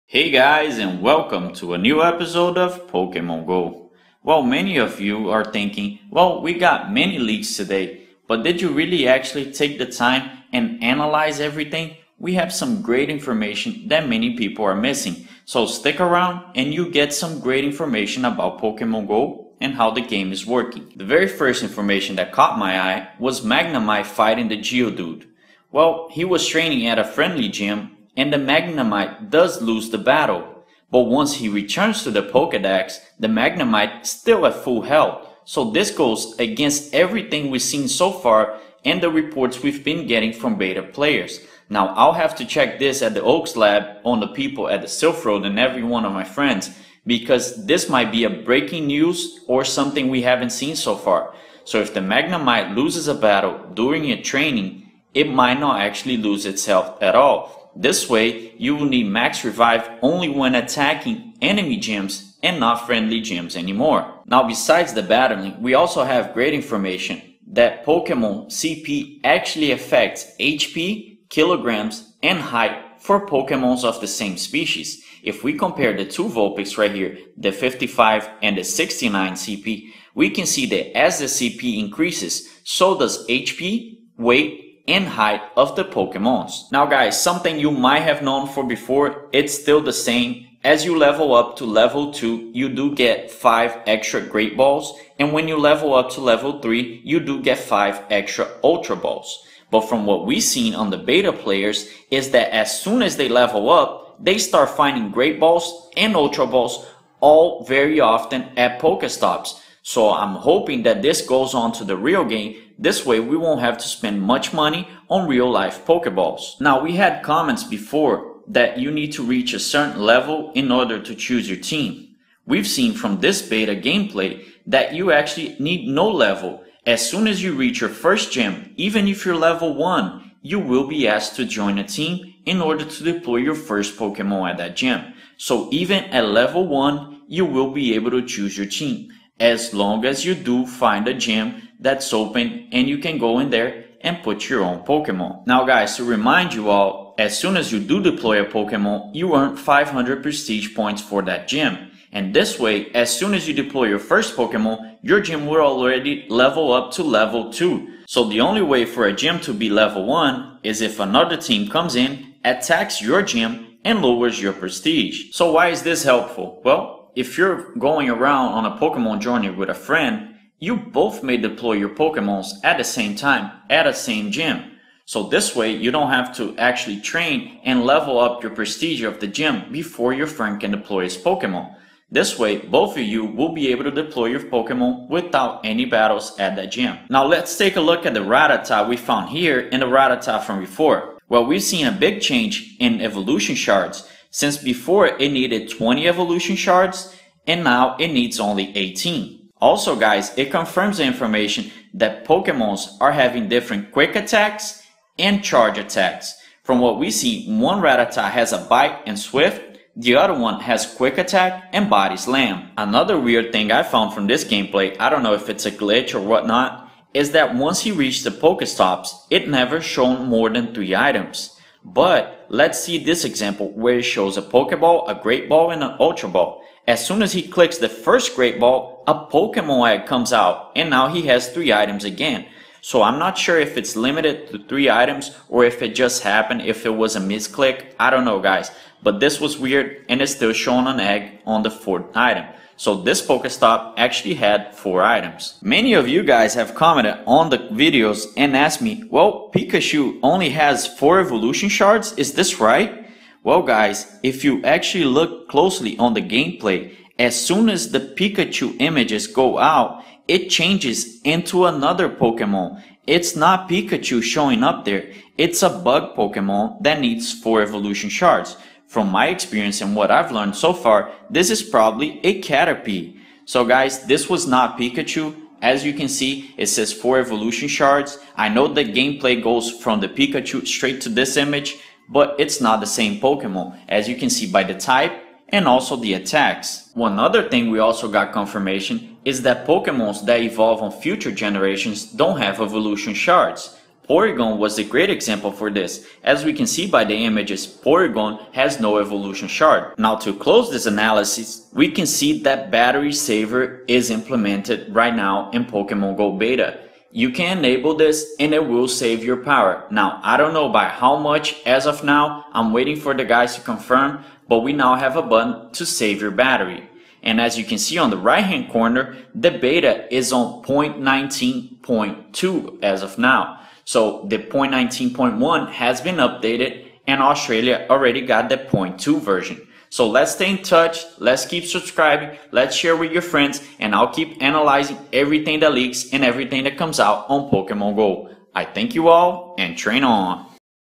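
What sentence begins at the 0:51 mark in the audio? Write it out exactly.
So if the Magnemite loses a battle during a training, it might not actually lose its health at all.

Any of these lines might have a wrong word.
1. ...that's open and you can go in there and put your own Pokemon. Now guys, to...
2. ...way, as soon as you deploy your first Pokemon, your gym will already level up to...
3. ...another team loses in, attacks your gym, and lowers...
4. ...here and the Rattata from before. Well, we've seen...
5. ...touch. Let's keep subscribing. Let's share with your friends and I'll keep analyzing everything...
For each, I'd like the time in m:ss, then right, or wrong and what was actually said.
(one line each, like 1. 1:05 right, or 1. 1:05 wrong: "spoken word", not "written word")
1. 2:21 right
2. 2:32 right
3. 2:40 wrong: "comes", not "loses"
4. 3:09 right
5. 5:30 right.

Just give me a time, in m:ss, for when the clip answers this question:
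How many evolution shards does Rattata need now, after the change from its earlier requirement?
3:18.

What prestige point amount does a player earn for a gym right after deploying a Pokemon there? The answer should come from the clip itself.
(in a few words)
500.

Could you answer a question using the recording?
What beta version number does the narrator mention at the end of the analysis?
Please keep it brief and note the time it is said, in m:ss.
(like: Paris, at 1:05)
0.19.2, at 5:20.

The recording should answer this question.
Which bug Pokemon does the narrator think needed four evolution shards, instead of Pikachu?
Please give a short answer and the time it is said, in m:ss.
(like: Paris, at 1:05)
Caterpie, at 4:32.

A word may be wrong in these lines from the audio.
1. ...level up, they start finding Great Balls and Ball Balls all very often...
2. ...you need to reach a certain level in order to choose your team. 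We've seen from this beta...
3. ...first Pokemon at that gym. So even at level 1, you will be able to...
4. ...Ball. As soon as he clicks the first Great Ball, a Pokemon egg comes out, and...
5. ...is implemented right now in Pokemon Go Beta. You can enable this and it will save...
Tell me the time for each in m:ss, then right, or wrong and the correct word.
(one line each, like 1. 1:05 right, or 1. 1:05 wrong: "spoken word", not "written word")
1. 1:43 wrong: "Ultra", not "Ball"
2. 1:58 right
3. 2:13 right
4. 3:46 right
5. 5:03 right.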